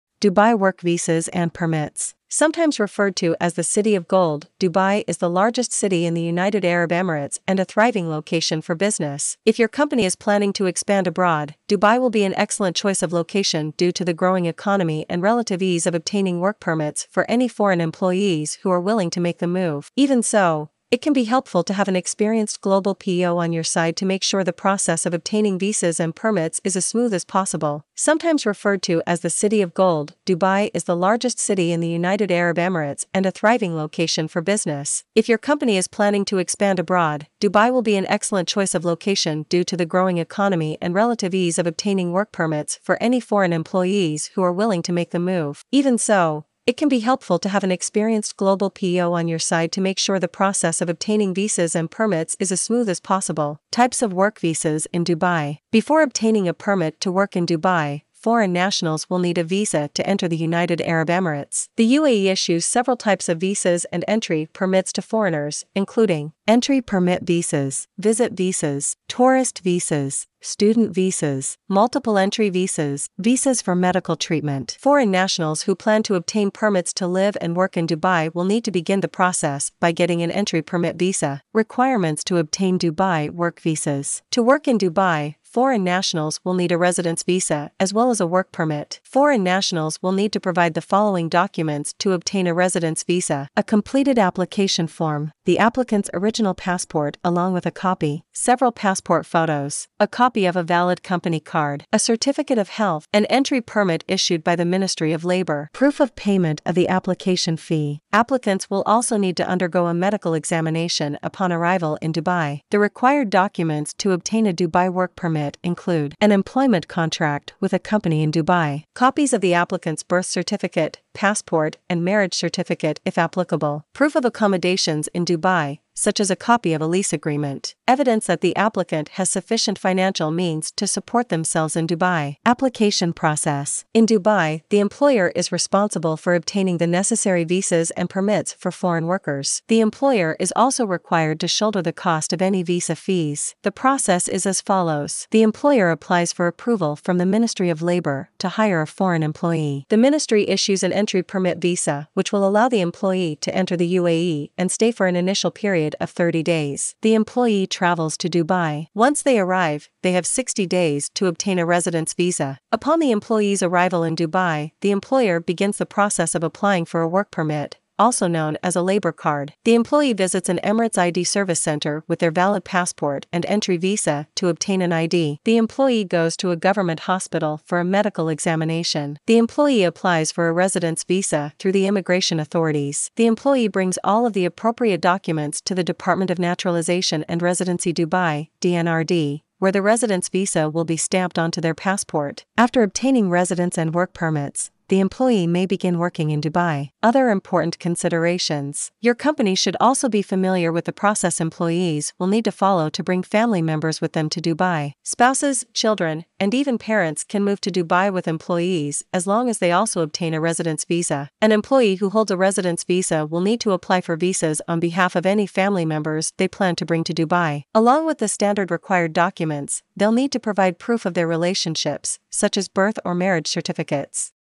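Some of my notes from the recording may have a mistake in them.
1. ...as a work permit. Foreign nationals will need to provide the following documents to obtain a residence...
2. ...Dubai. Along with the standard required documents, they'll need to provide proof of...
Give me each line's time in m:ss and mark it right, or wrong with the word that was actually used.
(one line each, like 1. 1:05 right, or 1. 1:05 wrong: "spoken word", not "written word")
1. 1:28 right
2. 3:37 right.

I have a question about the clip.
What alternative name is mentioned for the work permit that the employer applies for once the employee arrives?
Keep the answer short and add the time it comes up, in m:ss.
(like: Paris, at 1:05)
labor card, at 2:48.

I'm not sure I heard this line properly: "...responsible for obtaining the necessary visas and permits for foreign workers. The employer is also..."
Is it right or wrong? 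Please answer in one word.
right.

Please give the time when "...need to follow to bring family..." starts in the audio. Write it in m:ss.
3:22.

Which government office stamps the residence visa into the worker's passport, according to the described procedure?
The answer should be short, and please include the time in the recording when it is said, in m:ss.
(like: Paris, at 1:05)
Department of Naturalization and Residency Dubai, at 3:05.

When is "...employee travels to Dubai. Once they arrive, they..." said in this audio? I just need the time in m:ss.
2:37.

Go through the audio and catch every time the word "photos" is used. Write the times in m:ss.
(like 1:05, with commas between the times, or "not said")
1:39.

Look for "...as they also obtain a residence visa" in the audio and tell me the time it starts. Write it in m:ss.
3:29.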